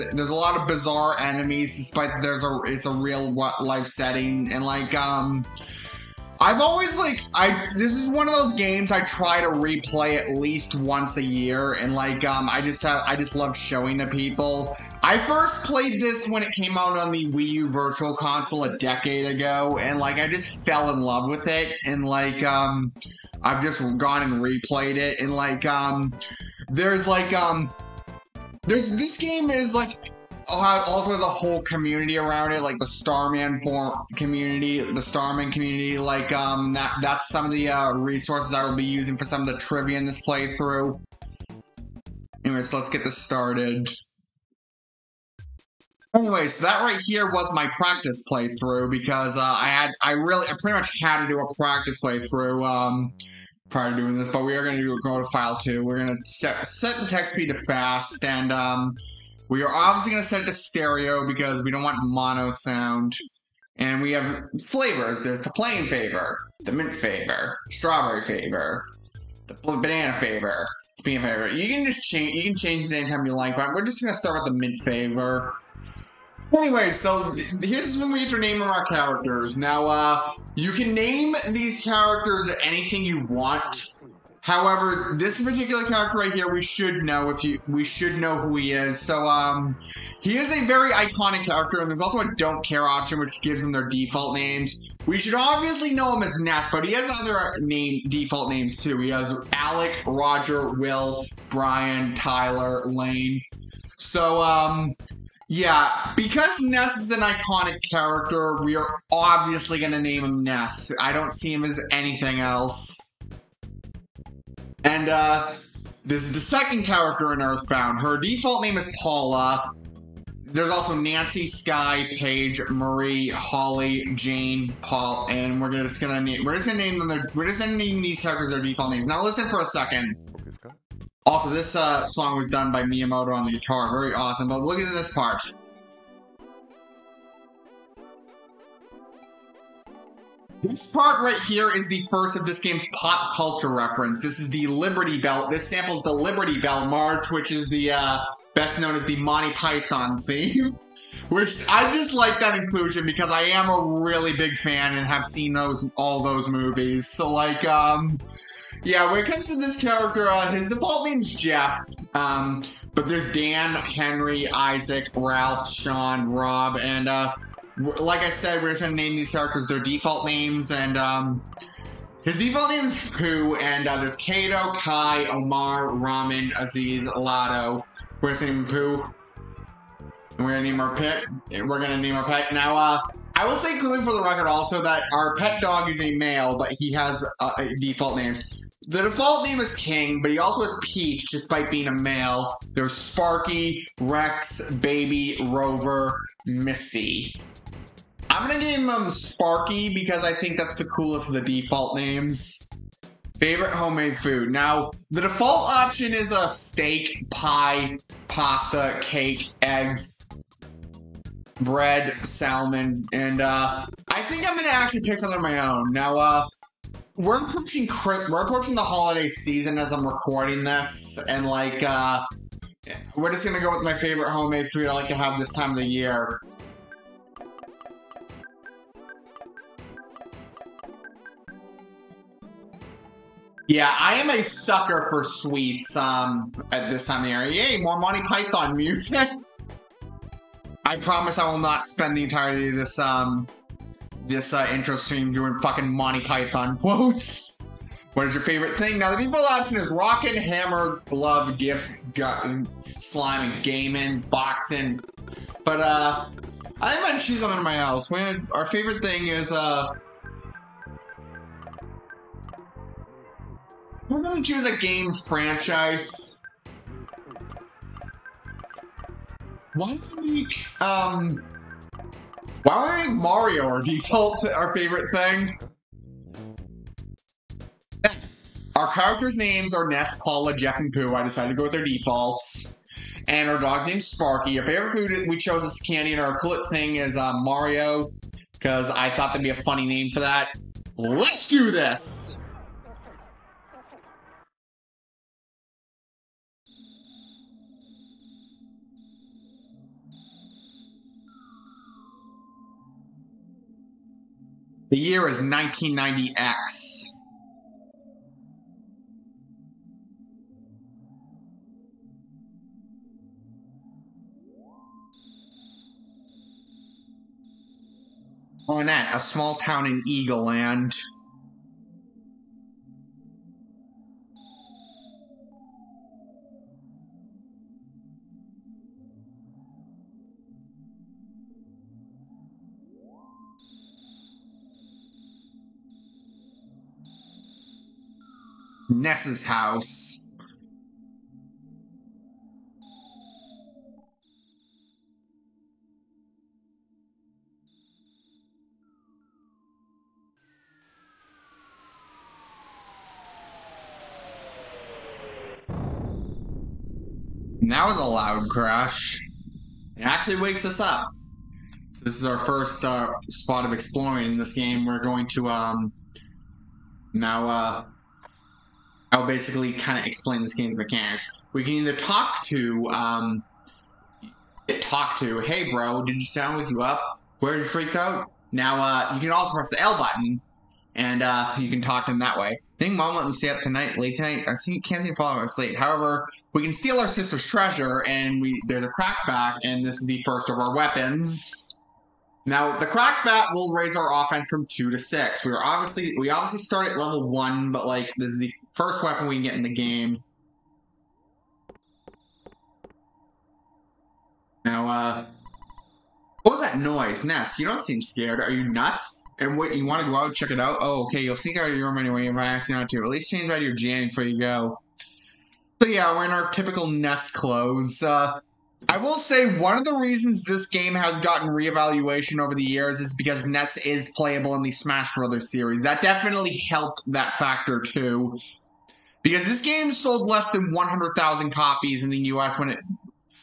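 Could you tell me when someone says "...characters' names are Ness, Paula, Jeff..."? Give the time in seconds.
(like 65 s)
278 s.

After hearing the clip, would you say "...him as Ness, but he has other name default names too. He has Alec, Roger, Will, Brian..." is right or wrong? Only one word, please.
right.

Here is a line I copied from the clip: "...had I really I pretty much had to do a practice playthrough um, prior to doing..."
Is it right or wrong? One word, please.
right.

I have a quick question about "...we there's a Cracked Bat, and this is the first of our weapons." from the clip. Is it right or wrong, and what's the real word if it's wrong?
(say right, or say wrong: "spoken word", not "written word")
right.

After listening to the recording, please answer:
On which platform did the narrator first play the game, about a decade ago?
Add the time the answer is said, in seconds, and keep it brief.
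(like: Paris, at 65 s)
Wii U Virtual Console, at 17 s.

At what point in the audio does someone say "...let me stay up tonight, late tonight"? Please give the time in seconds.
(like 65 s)
383 s.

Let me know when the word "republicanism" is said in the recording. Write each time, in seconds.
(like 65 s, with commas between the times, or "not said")
not said.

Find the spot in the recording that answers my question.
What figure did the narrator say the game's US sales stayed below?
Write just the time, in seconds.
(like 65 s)
430 s.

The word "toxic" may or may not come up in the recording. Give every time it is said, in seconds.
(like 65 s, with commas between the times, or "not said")
not said.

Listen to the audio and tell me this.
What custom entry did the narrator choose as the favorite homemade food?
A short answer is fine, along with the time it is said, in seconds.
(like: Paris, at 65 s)
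Candy, at 285 s.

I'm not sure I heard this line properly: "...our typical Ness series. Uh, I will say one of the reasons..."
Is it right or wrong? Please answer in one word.
wrong.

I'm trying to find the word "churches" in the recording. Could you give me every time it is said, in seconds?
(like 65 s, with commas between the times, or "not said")
not said.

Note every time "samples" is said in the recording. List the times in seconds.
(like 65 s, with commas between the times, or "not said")
145 s.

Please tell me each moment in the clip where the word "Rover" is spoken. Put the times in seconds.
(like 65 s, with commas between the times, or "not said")
195 s.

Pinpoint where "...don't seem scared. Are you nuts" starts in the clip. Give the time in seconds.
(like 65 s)
407 s.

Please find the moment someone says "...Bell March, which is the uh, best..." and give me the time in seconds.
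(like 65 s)
146 s.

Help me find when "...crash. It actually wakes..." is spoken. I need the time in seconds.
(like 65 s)
358 s.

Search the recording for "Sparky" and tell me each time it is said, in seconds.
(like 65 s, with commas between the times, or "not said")
192 s, 199 s, 284 s.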